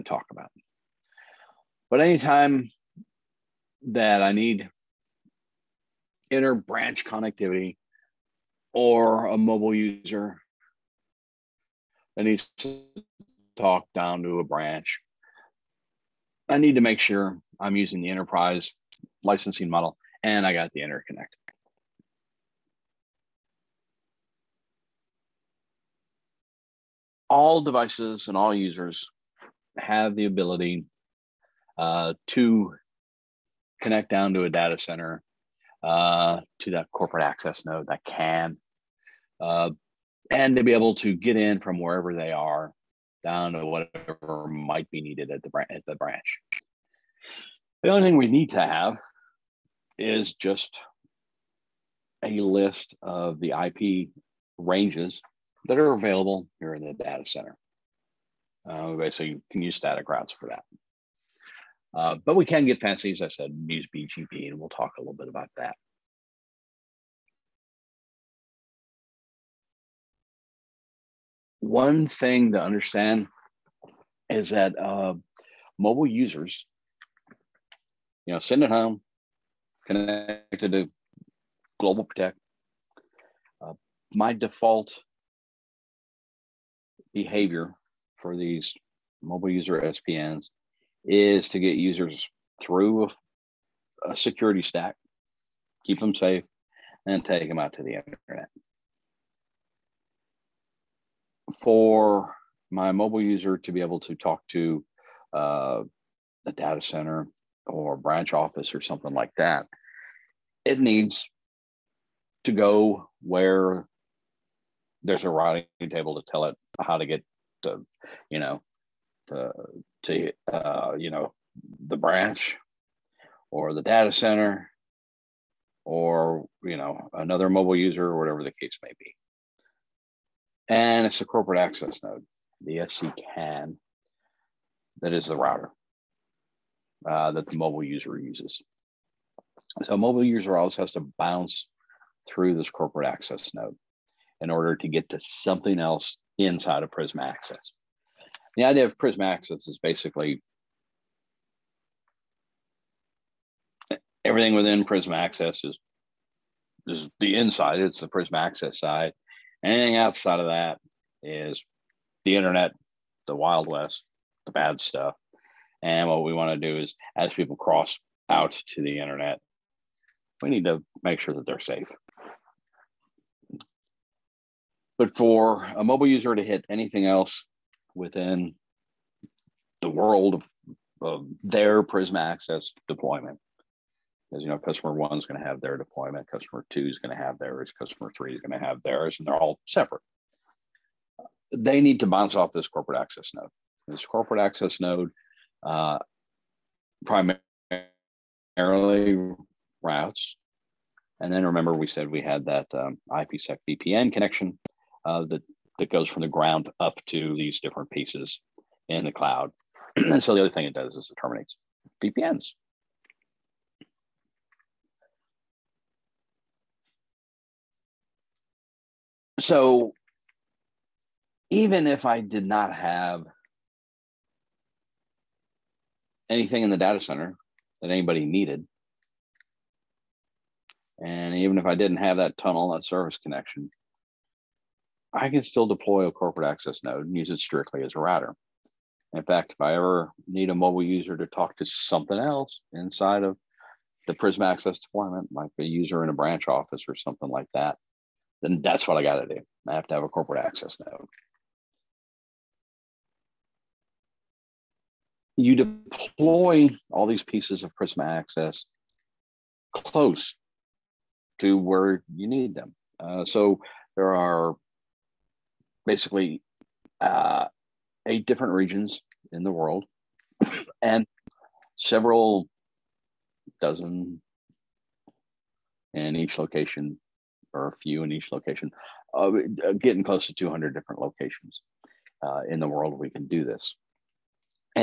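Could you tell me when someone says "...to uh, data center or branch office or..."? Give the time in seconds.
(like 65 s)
104 s.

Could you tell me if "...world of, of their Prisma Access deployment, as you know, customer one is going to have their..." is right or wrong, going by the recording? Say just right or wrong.
right.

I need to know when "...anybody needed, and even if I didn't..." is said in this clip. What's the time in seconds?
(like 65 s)
227 s.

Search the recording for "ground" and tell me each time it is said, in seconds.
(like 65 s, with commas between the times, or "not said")
206 s.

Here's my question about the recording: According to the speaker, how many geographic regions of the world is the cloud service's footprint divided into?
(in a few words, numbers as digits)
8.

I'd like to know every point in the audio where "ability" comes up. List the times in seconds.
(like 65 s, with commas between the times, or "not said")
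30 s.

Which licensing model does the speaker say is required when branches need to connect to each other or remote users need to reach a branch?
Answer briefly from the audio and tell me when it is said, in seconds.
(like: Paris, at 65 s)
Enterprise, at 18 s.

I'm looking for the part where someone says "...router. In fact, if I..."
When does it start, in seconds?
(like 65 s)
237 s.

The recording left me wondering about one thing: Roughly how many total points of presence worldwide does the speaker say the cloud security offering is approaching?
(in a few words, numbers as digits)
200.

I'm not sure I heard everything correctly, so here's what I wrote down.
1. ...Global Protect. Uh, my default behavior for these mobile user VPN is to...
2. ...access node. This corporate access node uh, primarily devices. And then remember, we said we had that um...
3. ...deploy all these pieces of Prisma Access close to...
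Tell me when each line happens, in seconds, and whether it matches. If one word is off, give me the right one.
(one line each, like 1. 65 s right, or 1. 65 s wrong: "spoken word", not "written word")
1. 81 s wrong: "SPNs", not "VPN"
2. 193 s wrong: "routes", not "devices"
3. 255 s right.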